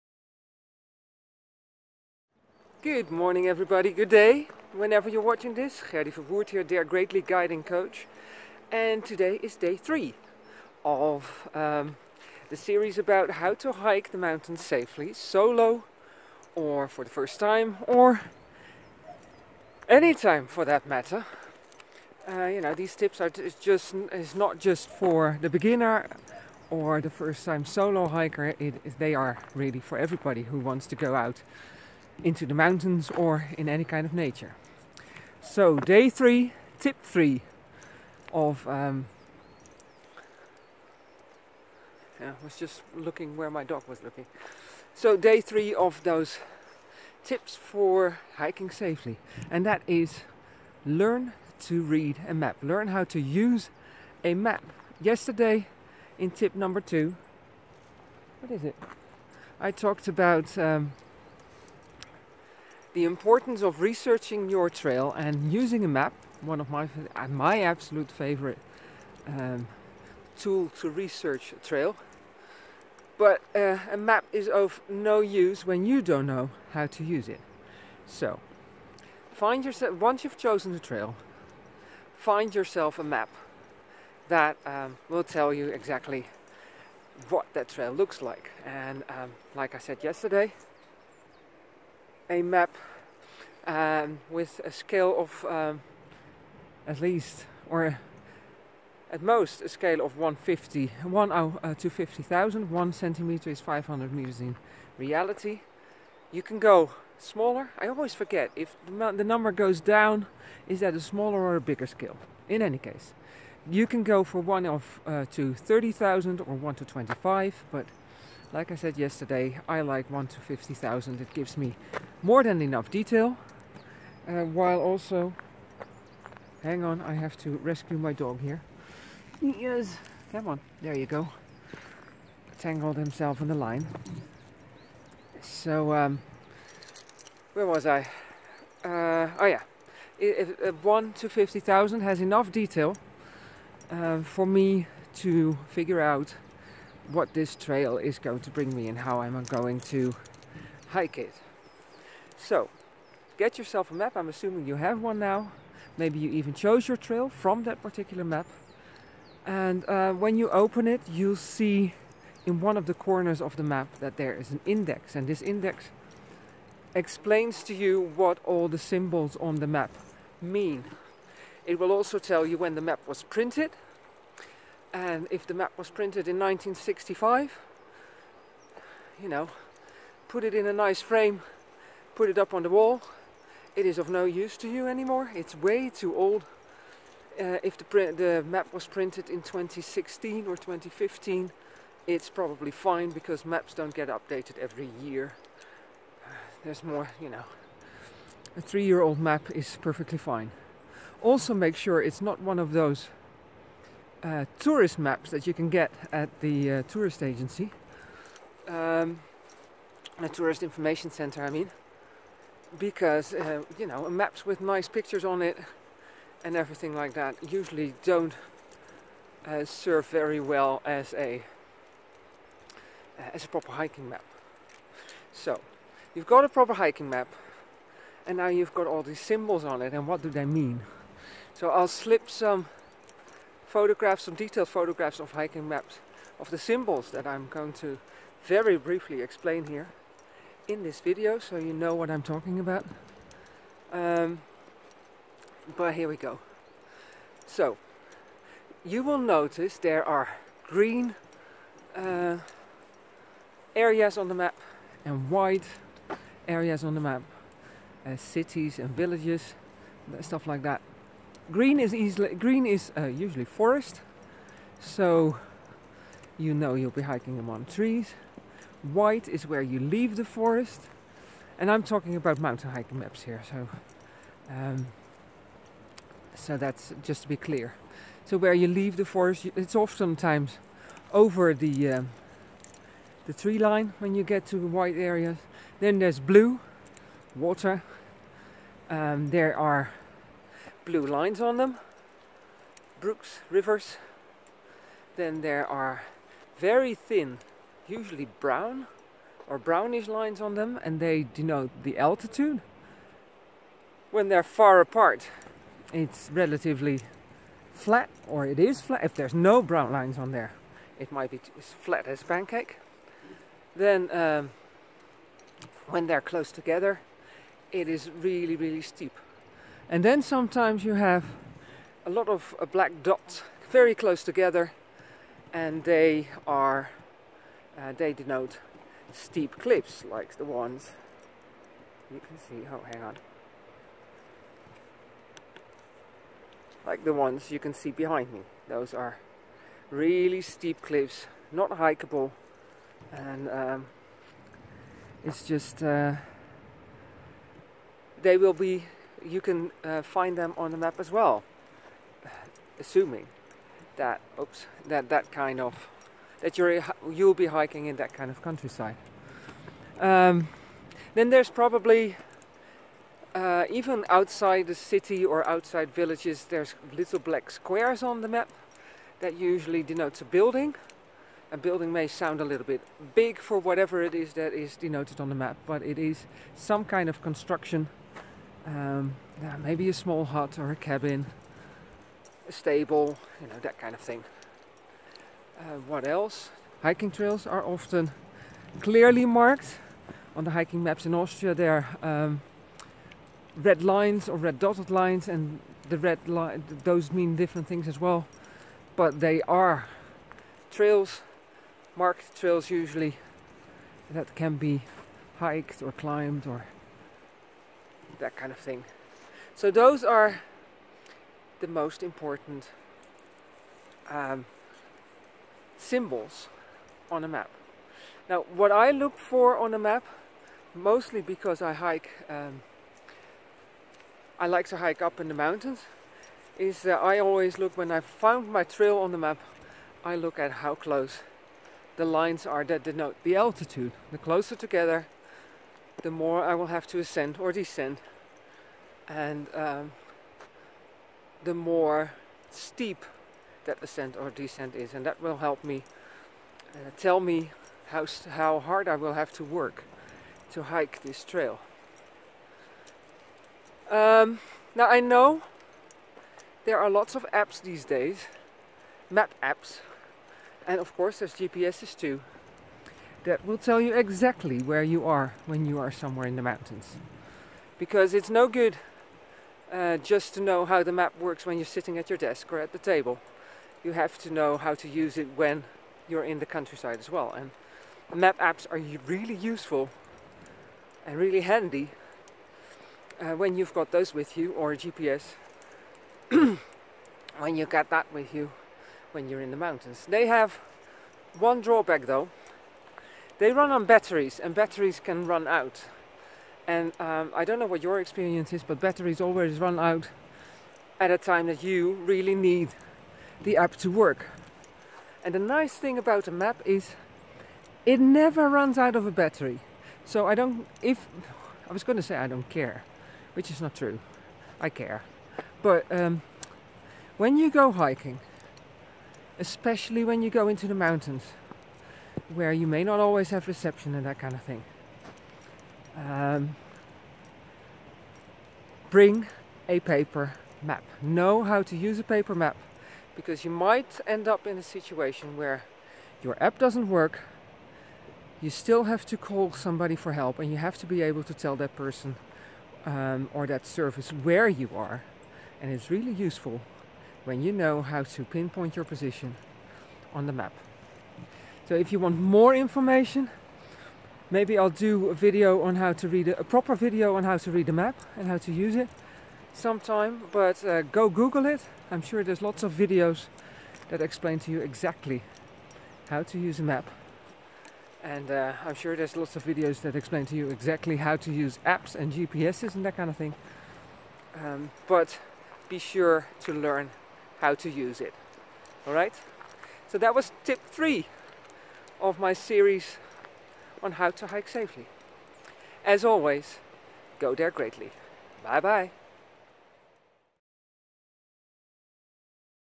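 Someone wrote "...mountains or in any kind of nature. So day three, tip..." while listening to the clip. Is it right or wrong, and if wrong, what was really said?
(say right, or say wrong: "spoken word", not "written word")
right.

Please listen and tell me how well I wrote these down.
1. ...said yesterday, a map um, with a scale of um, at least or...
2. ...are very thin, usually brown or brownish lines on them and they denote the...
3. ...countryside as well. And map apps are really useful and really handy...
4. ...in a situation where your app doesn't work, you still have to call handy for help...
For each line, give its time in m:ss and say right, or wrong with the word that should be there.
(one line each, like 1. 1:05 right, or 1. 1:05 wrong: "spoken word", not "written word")
1. 1:29 right
2. 4:55 right
3. 7:56 right
4. 8:54 wrong: "somebody", not "handy".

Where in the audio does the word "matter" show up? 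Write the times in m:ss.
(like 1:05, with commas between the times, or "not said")
0:20.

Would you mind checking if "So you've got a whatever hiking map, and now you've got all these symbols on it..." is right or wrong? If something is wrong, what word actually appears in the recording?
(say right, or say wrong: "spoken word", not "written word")
wrong: "proper", not "whatever".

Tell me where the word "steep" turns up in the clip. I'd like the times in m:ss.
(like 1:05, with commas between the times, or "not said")
5:18, 5:29, 5:40, 7:22.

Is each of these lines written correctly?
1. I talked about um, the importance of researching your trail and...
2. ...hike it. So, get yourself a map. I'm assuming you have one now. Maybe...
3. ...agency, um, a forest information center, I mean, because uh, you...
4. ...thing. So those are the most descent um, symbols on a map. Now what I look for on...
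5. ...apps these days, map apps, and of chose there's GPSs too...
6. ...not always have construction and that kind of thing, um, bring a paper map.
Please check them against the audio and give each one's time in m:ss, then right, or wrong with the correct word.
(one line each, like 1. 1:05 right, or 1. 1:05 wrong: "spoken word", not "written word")
1. 0:59 right
2. 2:30 right
3. 3:27 wrong: "tourist", not "forest"
4. 6:48 wrong: "important", not "descent"
5. 7:37 wrong: "course", not "chose"
6. 8:42 wrong: "reception", not "construction".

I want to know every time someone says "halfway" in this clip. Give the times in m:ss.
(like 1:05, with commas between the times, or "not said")
not said.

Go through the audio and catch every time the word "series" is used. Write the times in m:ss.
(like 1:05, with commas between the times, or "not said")
0:12, 9:42.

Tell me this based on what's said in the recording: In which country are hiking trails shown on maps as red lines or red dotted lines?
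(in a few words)
Austria.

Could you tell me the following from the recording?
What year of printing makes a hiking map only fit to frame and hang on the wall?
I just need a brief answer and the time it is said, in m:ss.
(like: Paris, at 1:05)
1965, at 2:56.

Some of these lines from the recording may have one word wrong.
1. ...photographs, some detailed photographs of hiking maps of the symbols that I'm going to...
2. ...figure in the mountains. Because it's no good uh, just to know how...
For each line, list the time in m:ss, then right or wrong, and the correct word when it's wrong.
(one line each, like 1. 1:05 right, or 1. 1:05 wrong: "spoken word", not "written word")
1. 3:53 right
2. 7:45 wrong: "somewhere", not "figure".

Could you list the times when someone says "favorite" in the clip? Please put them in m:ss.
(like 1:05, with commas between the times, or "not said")
1:08.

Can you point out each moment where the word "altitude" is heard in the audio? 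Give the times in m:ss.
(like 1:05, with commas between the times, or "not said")
5:01, 7:13.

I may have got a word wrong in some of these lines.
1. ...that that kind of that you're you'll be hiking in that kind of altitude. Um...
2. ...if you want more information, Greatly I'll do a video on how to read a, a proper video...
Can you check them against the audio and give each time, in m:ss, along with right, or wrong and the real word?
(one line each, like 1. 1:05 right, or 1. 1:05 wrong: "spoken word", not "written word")
1. 5:54 wrong: "countryside", not "altitude"
2. 9:11 wrong: "Maybe", not "Greatly".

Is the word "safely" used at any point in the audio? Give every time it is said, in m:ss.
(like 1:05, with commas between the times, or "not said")
0:14, 0:48, 9:44.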